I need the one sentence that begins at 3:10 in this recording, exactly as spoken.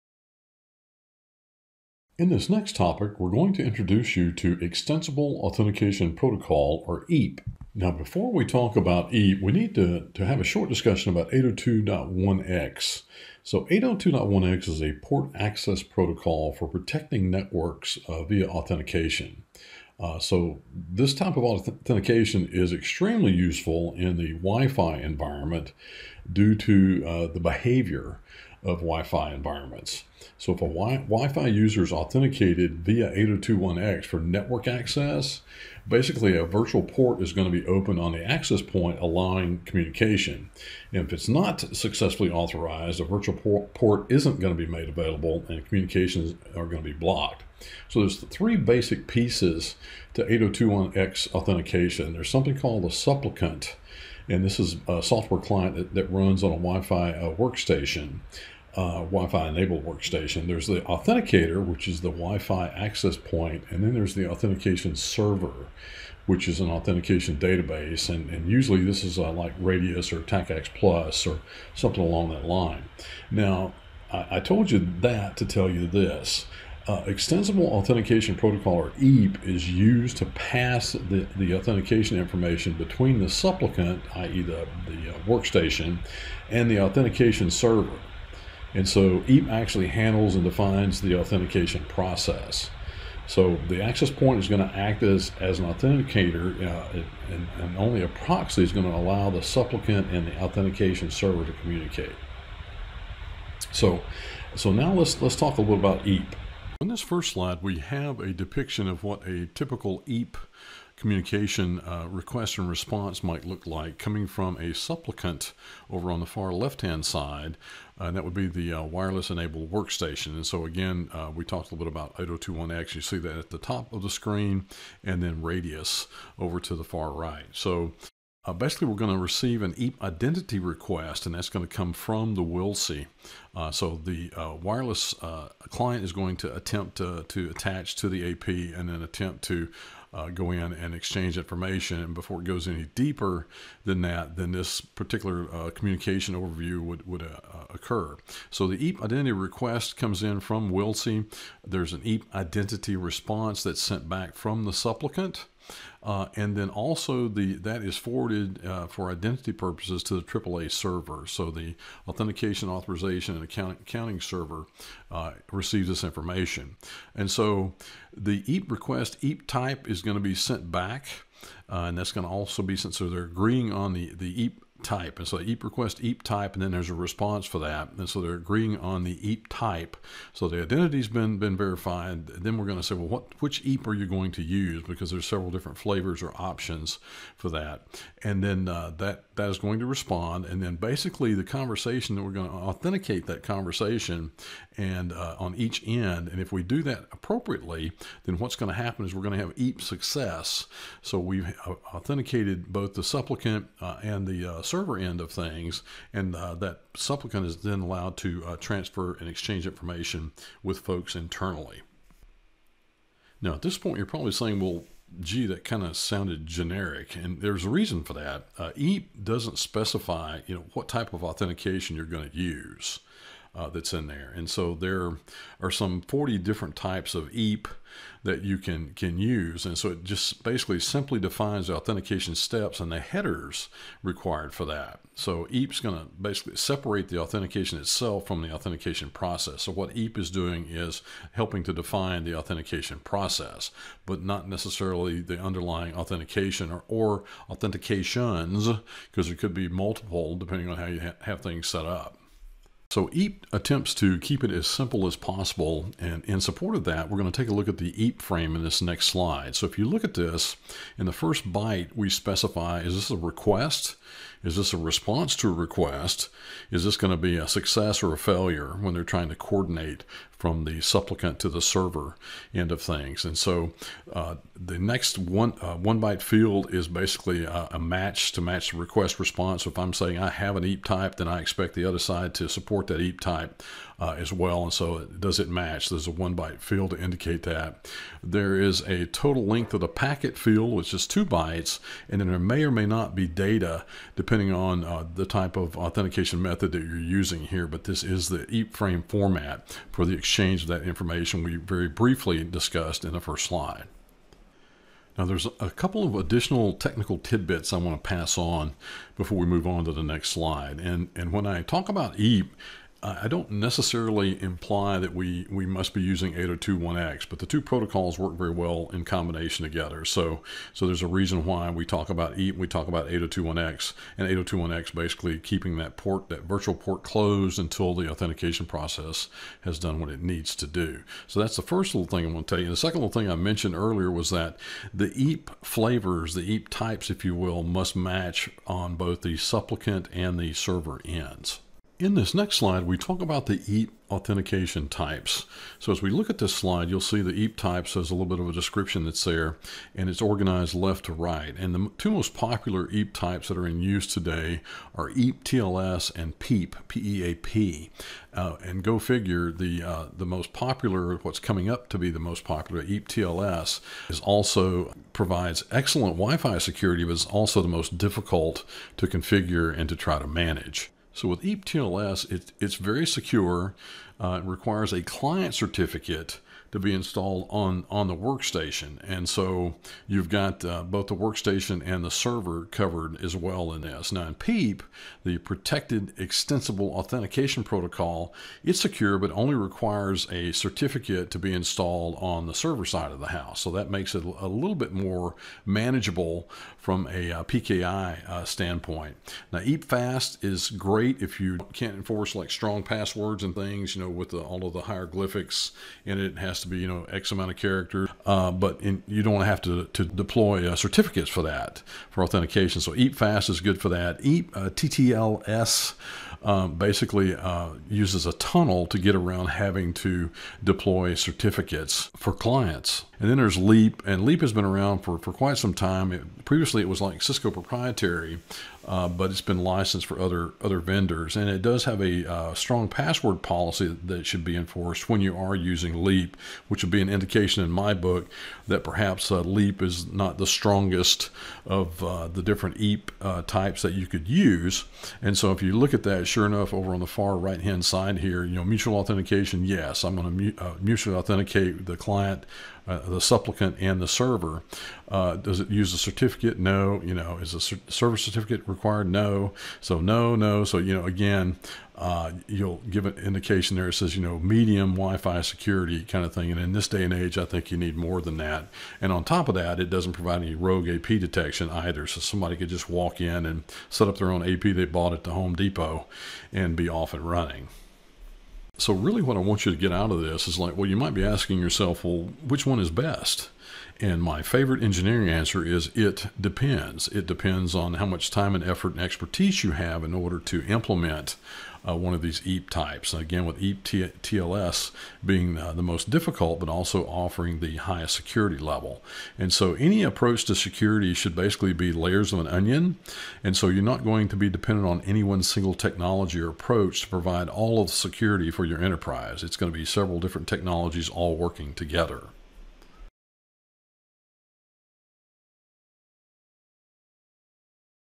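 And then basically the conversation that we're going to authenticate that conversation and uh, on each end.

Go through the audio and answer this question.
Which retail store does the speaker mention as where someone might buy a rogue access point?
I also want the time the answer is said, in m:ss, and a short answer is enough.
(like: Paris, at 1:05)
Home Depot, at 7:55.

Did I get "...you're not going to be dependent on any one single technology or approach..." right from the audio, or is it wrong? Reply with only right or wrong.
right.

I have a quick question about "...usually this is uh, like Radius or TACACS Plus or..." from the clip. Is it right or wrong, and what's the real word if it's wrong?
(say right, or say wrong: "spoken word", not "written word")
right.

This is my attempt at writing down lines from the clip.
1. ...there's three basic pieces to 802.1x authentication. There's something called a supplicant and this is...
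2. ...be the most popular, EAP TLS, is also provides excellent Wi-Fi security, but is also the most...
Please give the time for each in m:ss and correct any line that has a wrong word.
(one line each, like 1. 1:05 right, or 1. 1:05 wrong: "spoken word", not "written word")
1. 0:47 right
2. 6:01 right.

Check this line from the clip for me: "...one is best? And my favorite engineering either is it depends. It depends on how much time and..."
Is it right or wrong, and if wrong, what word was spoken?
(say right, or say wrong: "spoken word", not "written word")
wrong: "answer", not "either".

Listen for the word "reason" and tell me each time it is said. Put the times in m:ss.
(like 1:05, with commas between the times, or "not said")
3:37, 5:21.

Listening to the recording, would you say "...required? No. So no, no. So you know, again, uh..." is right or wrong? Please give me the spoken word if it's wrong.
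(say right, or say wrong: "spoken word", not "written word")
right.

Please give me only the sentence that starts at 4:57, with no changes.
But this is the EAP frame format for the exchange exchange of that information we very briefly discussed in the first slide.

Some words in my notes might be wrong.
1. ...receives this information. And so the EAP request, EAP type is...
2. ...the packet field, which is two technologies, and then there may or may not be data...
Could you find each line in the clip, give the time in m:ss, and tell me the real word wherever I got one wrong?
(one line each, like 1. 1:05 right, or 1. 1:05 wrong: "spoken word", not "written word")
1. 2:45 right
2. 4:49 wrong: "bytes", not "technologies".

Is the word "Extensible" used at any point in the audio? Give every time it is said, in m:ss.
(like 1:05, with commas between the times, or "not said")
0:04, 1:17, 6:26.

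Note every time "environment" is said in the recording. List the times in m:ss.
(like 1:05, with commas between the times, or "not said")
0:24, 0:29.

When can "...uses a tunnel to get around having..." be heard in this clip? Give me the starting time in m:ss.
6:57.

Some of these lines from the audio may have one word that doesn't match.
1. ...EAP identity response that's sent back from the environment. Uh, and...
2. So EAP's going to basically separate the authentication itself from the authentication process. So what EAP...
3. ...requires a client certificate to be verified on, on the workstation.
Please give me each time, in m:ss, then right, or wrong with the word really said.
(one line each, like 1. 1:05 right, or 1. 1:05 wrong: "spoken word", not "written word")
1. 2:32 wrong: "supplicant", not "environment"
2. 3:55 right
3. 6:14 wrong: "installed", not "verified".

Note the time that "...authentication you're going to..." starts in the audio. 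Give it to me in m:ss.
3:41.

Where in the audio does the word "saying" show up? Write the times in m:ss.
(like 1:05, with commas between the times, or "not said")
3:34, 4:39.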